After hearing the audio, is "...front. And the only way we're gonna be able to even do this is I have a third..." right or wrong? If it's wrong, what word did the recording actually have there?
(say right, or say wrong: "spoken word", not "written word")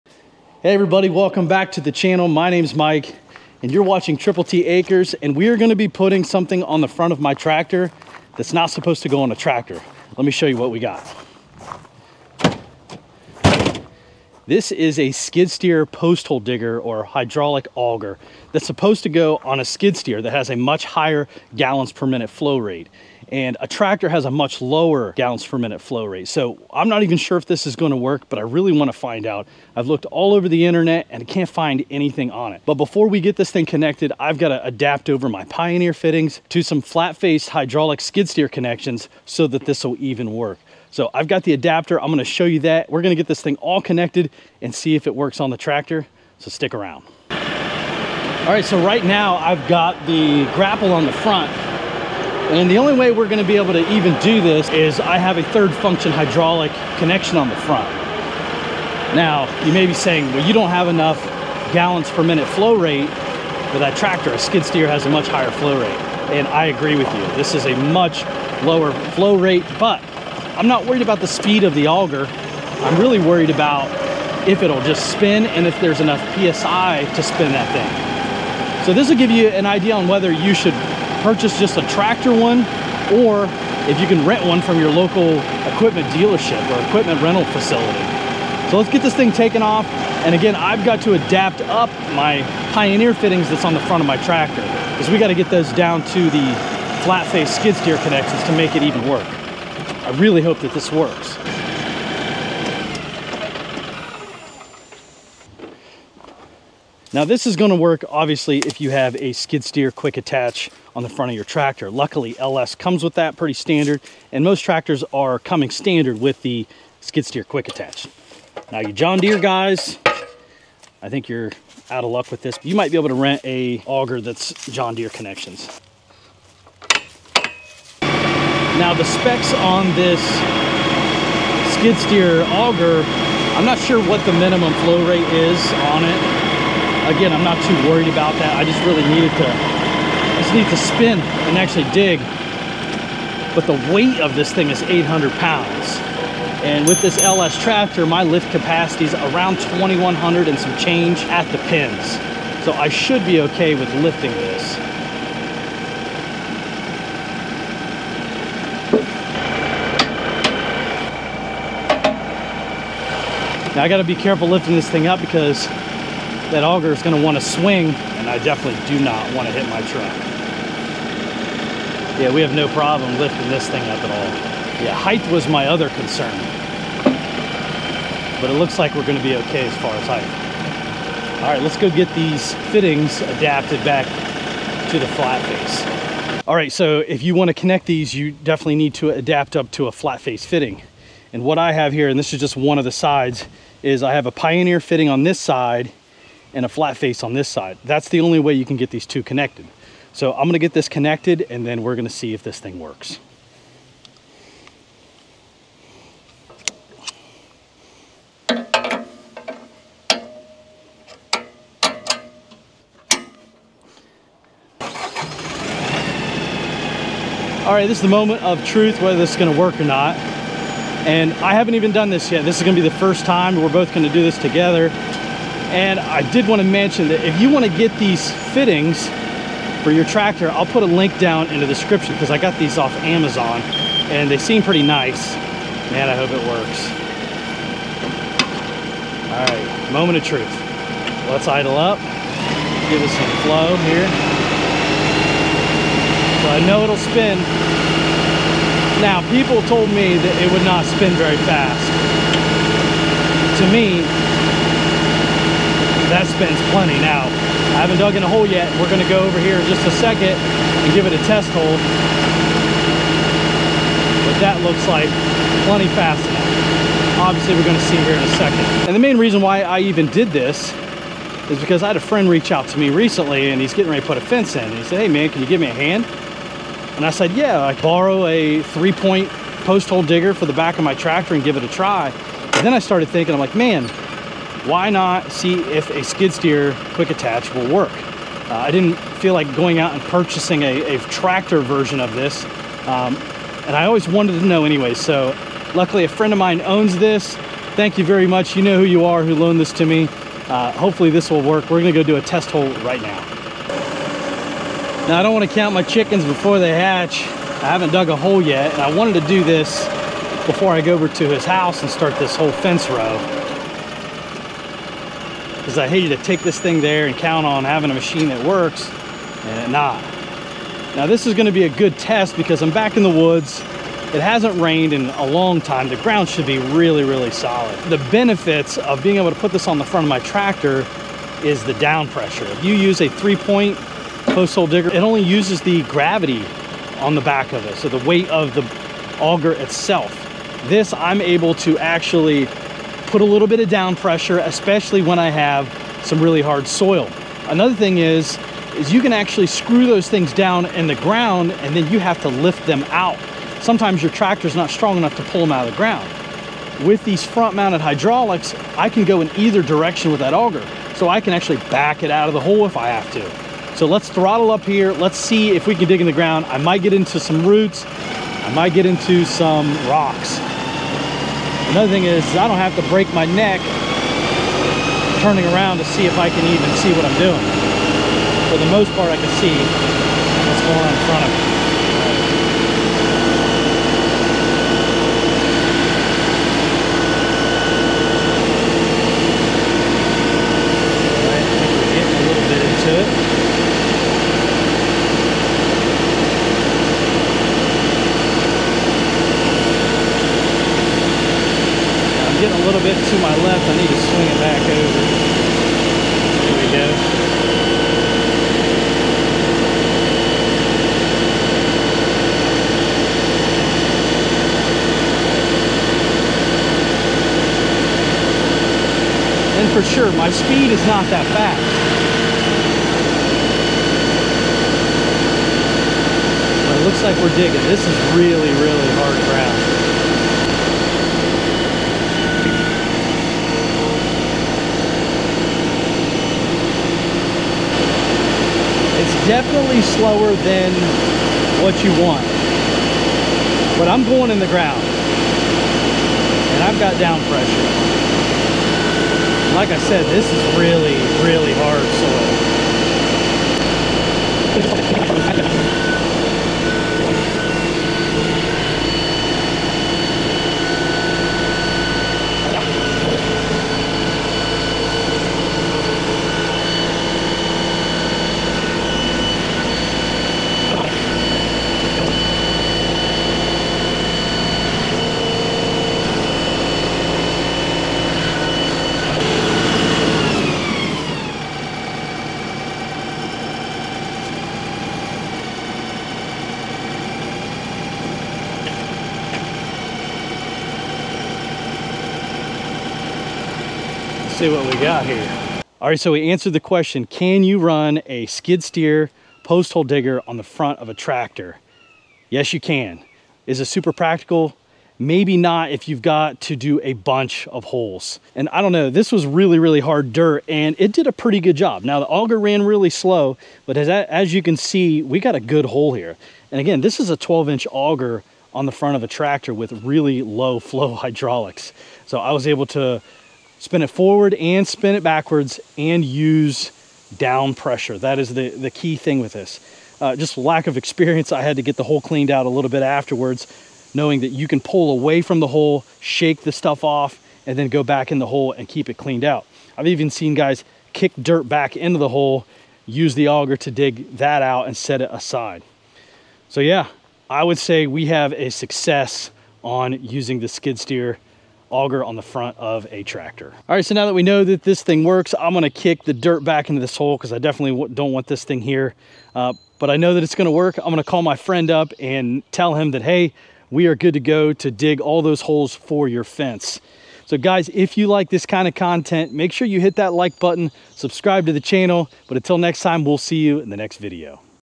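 right.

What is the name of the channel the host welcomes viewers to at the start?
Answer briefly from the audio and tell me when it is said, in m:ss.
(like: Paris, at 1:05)
Triple T Acres, at 0:04.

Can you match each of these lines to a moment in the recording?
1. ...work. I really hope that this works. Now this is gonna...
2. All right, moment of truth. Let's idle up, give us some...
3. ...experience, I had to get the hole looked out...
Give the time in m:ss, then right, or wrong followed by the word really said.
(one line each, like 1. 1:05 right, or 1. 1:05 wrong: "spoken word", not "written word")
1. 1:39 right
2. 3:59 right
3. 8:50 wrong: "cleaned", not "looked".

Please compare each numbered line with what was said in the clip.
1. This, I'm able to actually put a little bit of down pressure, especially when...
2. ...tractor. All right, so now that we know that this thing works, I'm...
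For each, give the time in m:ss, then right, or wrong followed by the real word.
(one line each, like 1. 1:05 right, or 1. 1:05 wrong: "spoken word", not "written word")
1. 5:40 right
2. 9:13 right.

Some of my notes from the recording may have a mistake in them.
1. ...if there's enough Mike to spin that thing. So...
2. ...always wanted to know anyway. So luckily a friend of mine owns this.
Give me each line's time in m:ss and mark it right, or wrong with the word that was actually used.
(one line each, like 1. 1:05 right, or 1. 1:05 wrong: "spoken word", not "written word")
1. 1:15 wrong: "PSI", not "Mike"
2. 4:53 right.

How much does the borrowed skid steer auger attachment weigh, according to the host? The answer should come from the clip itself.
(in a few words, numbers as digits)
800 pounds.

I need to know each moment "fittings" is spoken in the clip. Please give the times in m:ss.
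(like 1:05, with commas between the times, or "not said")
0:35, 1:33, 3:02, 3:10, 3:14, 3:48.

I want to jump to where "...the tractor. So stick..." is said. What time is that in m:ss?
0:45.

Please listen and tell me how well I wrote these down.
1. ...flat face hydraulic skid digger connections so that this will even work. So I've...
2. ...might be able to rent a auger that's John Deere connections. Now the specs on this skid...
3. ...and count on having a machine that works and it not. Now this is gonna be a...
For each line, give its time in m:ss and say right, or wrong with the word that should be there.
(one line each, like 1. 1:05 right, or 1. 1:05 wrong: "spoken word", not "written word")
1. 0:36 wrong: "steer", not "digger"
2. 2:02 right
3. 5:17 right.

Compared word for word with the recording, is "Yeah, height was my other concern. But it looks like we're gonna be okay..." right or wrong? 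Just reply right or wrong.
right.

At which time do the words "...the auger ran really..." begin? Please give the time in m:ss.
8:31.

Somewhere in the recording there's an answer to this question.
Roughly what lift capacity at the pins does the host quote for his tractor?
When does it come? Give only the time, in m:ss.
2:29.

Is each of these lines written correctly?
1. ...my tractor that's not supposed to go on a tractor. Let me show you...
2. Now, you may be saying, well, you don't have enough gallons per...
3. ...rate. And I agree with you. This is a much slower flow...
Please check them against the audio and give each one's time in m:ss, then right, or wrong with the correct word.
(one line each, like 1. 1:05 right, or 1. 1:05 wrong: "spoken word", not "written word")
1. 0:07 right
2. 0:59 right
3. 1:05 wrong: "lower", not "slower".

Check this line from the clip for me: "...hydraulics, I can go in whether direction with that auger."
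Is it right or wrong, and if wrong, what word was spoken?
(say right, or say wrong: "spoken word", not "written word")
wrong: "either", not "whether".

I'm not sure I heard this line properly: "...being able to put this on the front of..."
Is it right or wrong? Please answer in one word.
right.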